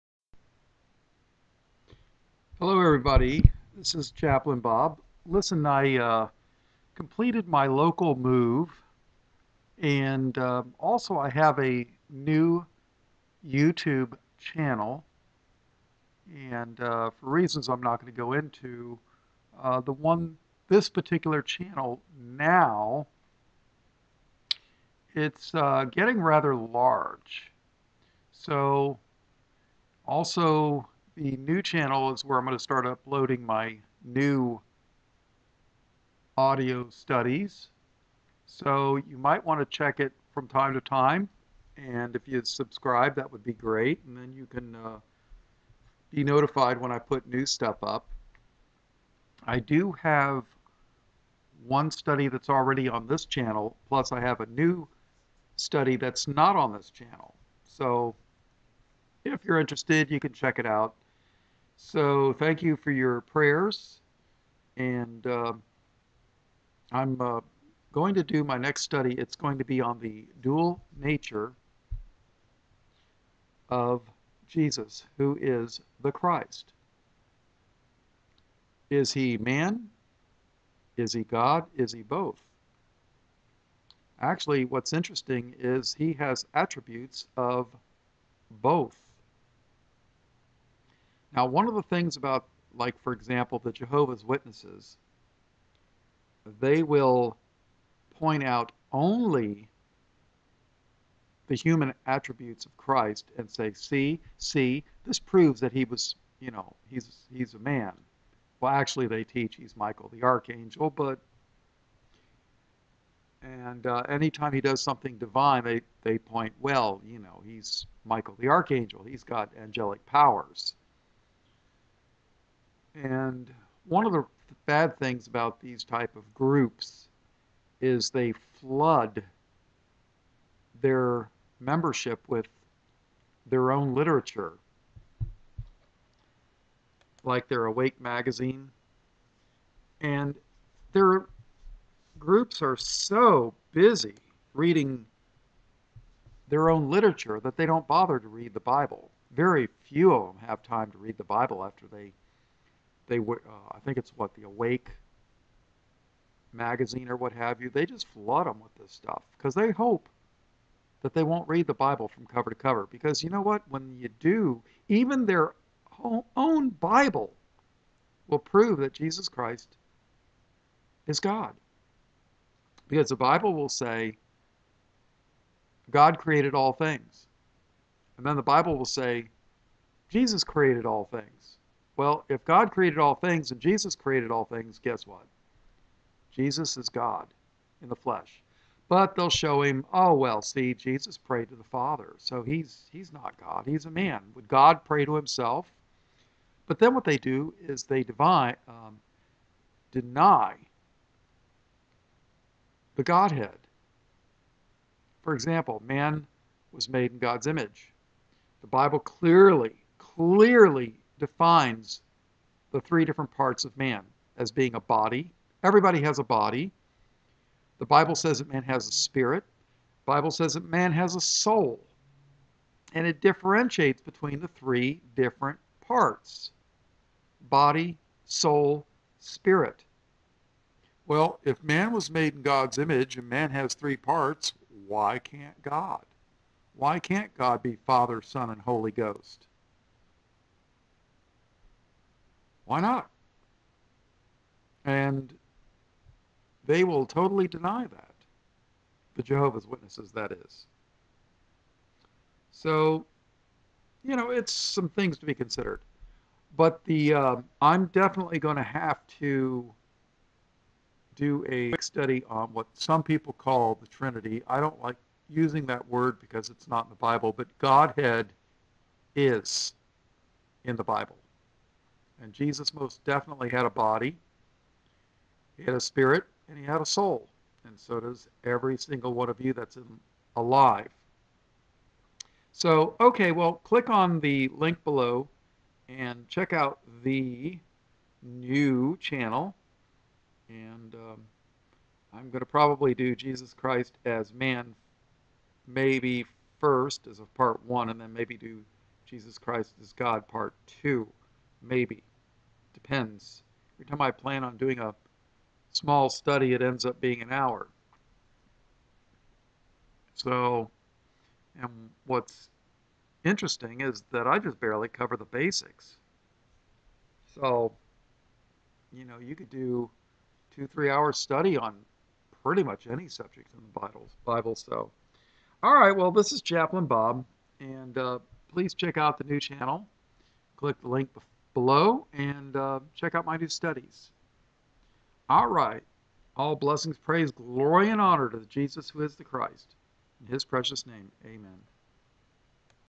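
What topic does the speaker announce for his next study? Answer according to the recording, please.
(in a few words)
The dual nature of Jesus.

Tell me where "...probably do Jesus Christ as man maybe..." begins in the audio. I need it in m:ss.
4:52.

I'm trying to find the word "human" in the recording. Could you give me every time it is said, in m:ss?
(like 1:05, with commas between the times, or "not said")
1:41.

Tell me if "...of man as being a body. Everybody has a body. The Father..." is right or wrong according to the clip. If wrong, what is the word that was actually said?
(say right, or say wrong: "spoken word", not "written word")
wrong: "Bible", not "Father".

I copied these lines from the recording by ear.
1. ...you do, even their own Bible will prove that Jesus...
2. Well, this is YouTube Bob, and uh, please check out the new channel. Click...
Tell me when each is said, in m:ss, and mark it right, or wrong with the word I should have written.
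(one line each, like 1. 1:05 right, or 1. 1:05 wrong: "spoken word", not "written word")
1. 2:43 right
2. 5:25 wrong: "Chaplain", not "YouTube".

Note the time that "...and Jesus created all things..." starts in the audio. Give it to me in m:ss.
3:03.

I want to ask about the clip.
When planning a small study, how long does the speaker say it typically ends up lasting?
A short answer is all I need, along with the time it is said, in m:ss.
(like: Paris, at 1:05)
An hour, at 5:07.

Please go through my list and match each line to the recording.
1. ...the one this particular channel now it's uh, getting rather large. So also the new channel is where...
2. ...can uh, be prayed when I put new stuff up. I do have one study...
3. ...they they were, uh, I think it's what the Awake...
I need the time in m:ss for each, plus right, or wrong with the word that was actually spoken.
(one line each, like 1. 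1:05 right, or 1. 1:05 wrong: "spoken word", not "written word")
1. 0:19 right
2. 0:44 wrong: "notified", not "prayed"
3. 2:31 right.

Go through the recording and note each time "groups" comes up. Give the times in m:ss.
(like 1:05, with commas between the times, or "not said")
2:06, 2:22.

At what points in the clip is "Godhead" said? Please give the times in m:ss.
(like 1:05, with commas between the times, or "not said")
3:23, 4:27.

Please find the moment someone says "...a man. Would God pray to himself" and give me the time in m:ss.
3:13.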